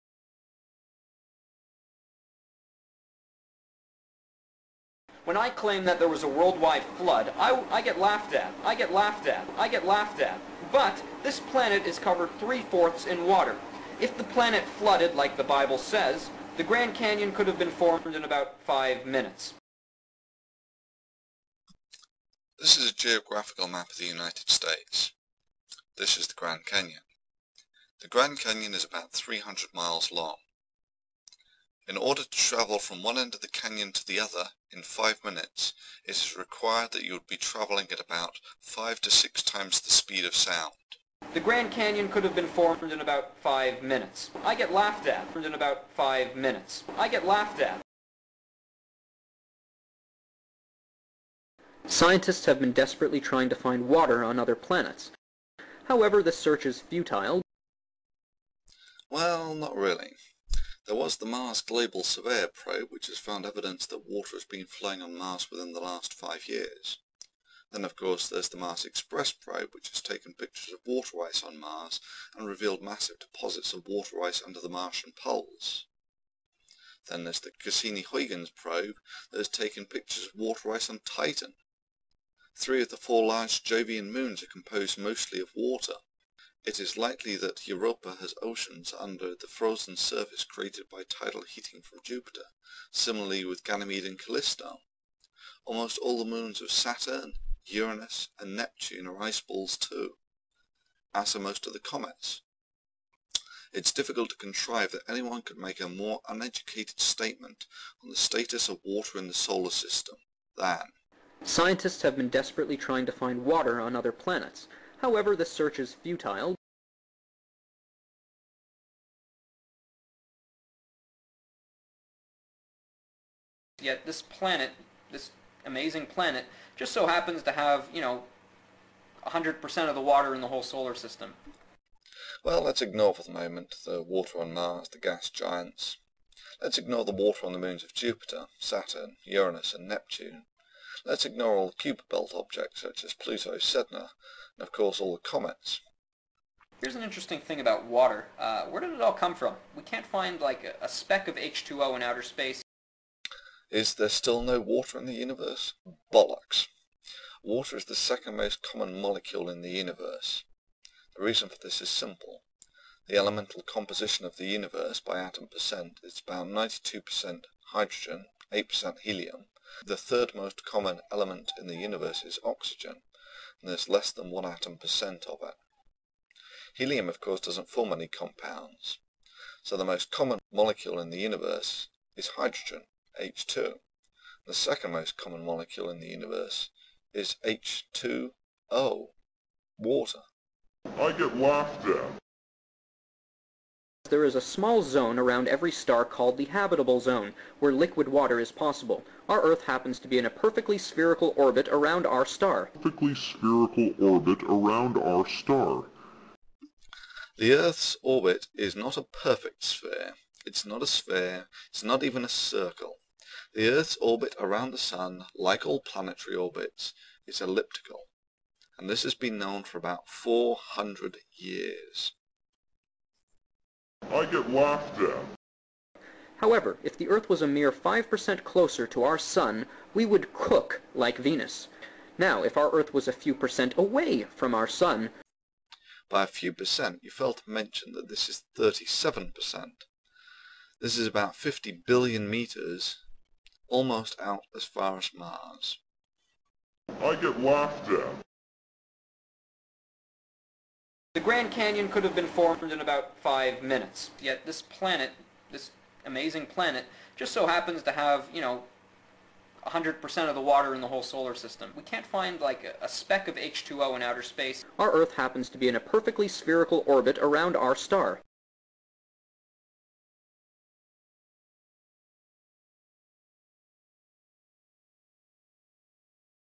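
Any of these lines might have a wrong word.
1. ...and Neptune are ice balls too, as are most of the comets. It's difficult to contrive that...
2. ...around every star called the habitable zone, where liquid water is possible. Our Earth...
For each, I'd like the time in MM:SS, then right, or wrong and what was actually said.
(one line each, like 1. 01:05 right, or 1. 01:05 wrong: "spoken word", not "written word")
1. 01:38 right
2. 03:15 right.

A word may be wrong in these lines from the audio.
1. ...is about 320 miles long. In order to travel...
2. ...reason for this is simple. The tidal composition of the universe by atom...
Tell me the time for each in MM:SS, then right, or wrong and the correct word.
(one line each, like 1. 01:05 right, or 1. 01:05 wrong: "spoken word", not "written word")
1. 00:28 wrong: "300", not "320"
2. 02:41 wrong: "elemental", not "tidal".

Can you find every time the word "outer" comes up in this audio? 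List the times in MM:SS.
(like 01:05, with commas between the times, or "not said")
02:32, 04:24.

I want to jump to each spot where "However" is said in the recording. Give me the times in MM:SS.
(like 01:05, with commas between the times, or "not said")
00:55, 01:55, 03:46.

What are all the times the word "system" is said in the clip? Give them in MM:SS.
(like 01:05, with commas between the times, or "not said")
01:49, 02:10, 04:21.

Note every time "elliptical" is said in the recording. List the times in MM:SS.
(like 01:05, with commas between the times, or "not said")
03:37.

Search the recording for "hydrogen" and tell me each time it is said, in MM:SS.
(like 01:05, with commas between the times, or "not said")
02:47, 03:02.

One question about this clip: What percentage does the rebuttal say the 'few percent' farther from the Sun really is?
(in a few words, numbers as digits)
37%.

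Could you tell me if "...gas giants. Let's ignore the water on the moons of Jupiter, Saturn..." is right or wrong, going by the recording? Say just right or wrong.
right.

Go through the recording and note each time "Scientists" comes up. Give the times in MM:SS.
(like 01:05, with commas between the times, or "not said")
00:51, 01:51.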